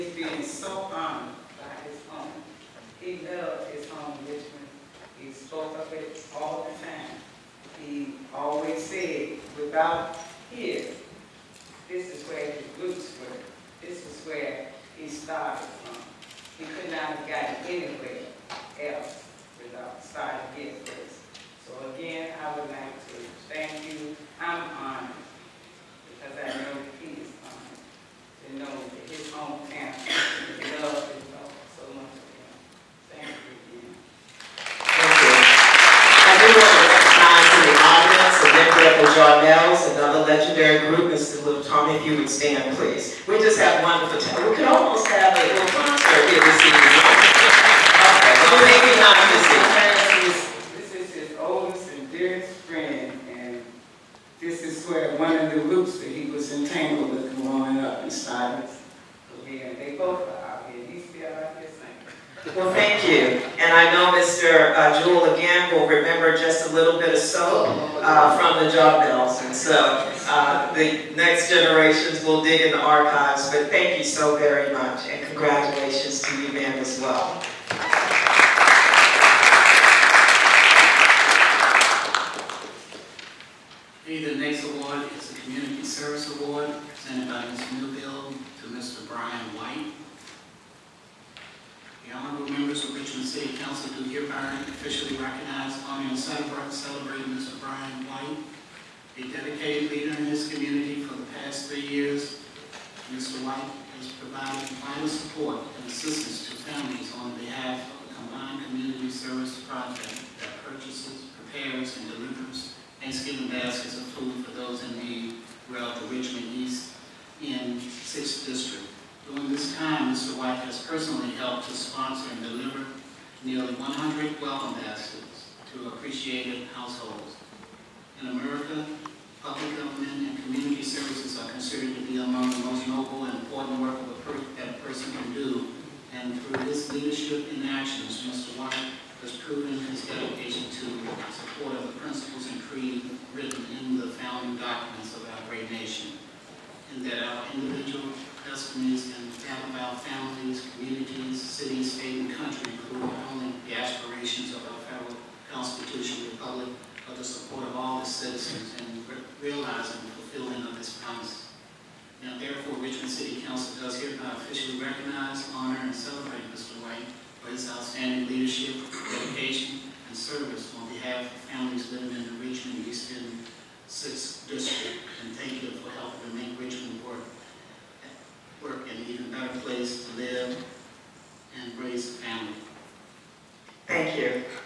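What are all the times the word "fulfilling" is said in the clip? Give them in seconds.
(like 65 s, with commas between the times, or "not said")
160 s.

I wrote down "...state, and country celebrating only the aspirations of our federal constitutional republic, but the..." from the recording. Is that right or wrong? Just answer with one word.
wrong.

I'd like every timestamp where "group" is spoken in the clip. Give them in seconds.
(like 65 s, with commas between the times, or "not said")
40 s, 55 s.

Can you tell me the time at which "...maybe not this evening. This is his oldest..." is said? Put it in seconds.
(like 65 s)
48 s.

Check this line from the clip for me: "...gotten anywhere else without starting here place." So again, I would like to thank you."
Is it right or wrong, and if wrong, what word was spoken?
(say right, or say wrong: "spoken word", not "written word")
right.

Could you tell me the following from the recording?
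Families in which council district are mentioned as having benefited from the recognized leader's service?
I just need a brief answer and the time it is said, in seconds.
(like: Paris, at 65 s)
6th District, at 173 s.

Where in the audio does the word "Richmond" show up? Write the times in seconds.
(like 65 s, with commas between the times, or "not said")
4 s, 92 s, 162 s, 172 s, 176 s.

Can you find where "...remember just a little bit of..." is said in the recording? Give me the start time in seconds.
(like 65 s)
65 s.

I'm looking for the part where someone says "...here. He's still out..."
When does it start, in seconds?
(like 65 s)
60 s.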